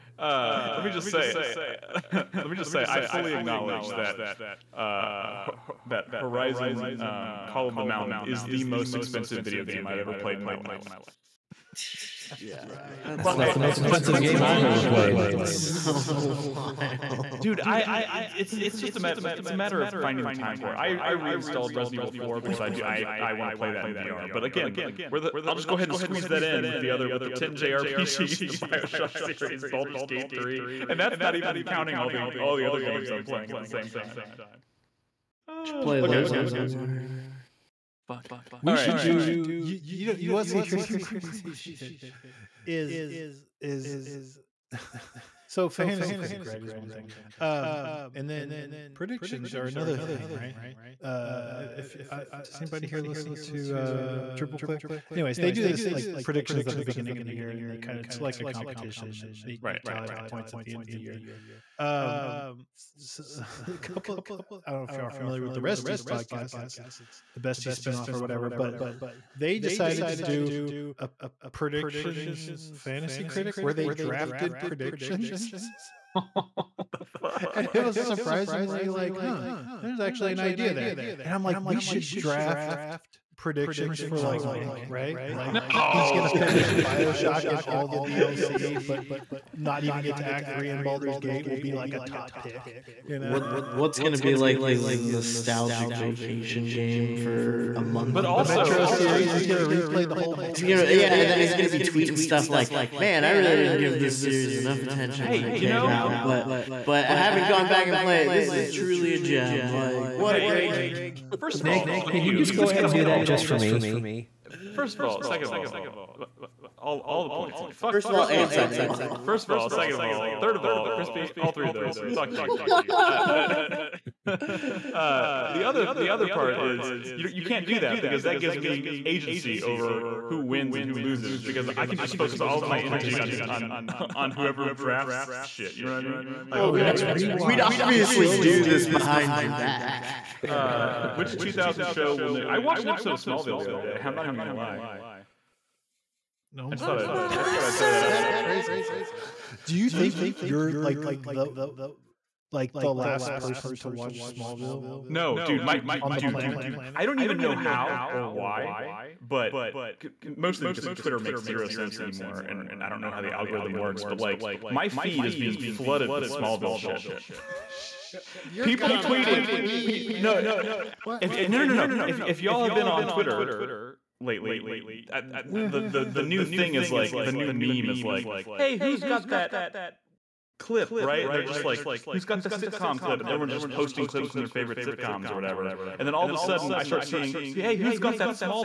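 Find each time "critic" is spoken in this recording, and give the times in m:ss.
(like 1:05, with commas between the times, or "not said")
0:46, 1:13.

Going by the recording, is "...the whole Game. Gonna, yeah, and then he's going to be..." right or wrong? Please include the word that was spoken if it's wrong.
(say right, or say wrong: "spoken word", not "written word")
wrong: "Metro", not "Game".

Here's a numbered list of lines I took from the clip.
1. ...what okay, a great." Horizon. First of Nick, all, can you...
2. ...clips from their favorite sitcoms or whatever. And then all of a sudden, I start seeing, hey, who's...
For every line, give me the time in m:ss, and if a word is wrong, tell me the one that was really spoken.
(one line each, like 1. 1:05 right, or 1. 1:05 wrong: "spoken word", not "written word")
1. 1:50 wrong: "Game", not "Horizon"
2. 3:04 right.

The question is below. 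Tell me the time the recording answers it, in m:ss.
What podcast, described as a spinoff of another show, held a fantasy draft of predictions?
1:05.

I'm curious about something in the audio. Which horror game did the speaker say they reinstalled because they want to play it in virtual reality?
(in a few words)
Resident Evil 4.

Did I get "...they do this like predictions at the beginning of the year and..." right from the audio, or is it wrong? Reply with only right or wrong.
right.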